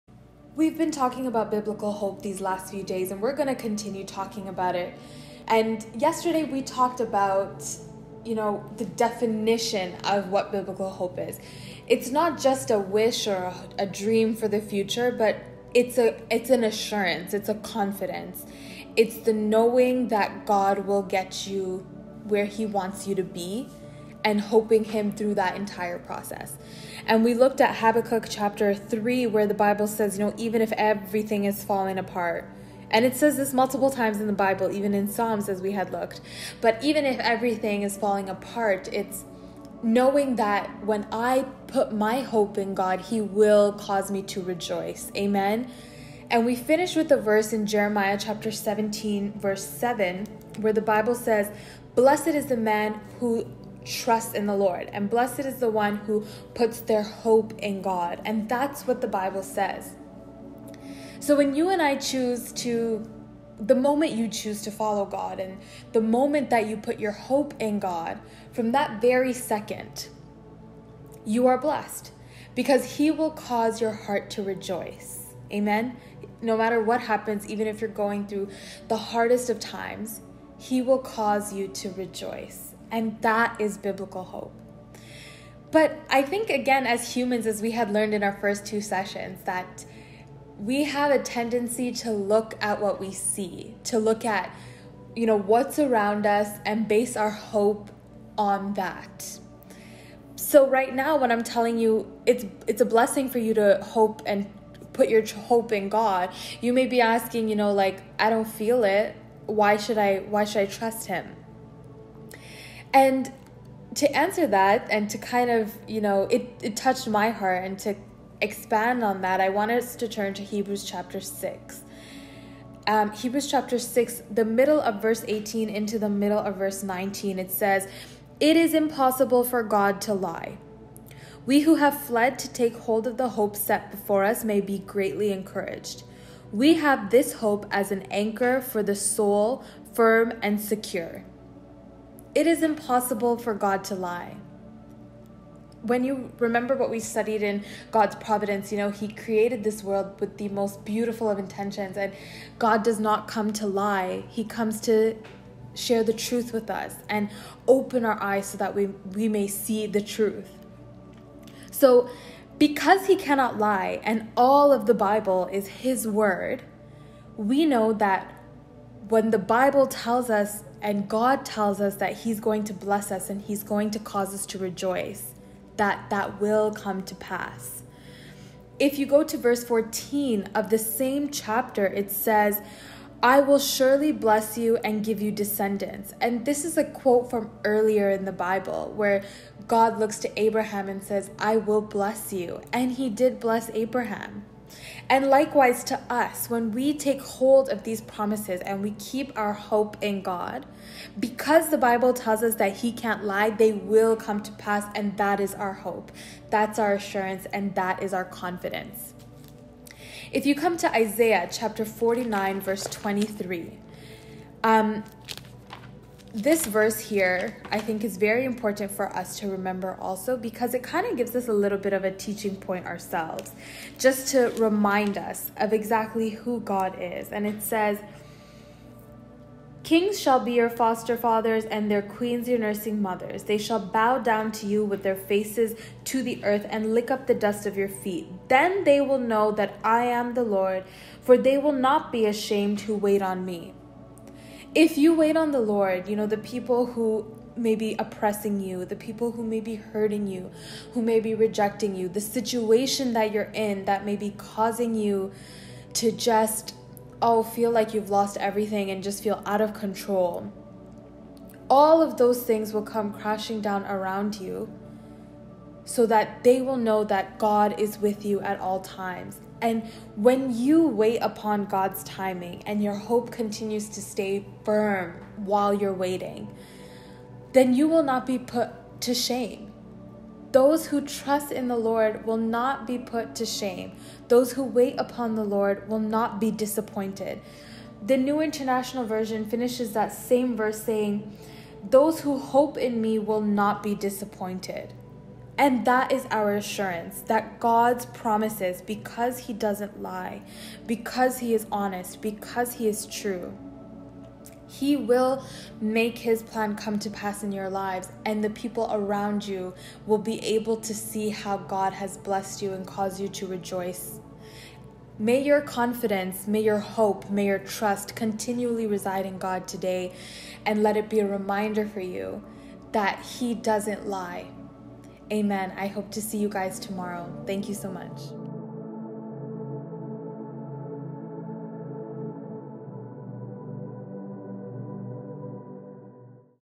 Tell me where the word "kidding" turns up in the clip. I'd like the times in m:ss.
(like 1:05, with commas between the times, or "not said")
not said.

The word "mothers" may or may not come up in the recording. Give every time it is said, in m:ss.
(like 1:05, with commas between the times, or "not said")
3:53.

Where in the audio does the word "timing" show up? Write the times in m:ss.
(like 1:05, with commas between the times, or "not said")
4:32.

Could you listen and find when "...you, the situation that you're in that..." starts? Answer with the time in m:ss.
4:11.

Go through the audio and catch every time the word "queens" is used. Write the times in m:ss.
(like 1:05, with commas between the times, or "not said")
3:52.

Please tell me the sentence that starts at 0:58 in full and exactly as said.
And that's what the Bible says.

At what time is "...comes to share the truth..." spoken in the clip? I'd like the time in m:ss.
2:34.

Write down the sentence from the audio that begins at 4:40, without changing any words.
Those who trust in the Lord will not be put to shame.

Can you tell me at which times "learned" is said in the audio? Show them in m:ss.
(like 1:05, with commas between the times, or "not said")
1:27.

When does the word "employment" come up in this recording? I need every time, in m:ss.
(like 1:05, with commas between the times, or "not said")
not said.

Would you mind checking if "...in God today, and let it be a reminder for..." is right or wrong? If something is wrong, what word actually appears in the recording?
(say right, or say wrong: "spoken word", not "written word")
right.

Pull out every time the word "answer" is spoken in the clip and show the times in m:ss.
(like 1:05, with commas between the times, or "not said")
1:54.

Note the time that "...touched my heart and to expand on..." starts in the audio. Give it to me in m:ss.
1:56.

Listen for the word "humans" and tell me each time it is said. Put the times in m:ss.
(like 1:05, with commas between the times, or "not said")
1:27.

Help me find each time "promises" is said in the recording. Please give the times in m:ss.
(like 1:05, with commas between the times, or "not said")
3:18, 4:58.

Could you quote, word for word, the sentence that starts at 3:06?
And this is a quote from earlier in the Bible where God looks to Abraham and says, I will bless you.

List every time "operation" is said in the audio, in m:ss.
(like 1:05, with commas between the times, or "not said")
not said.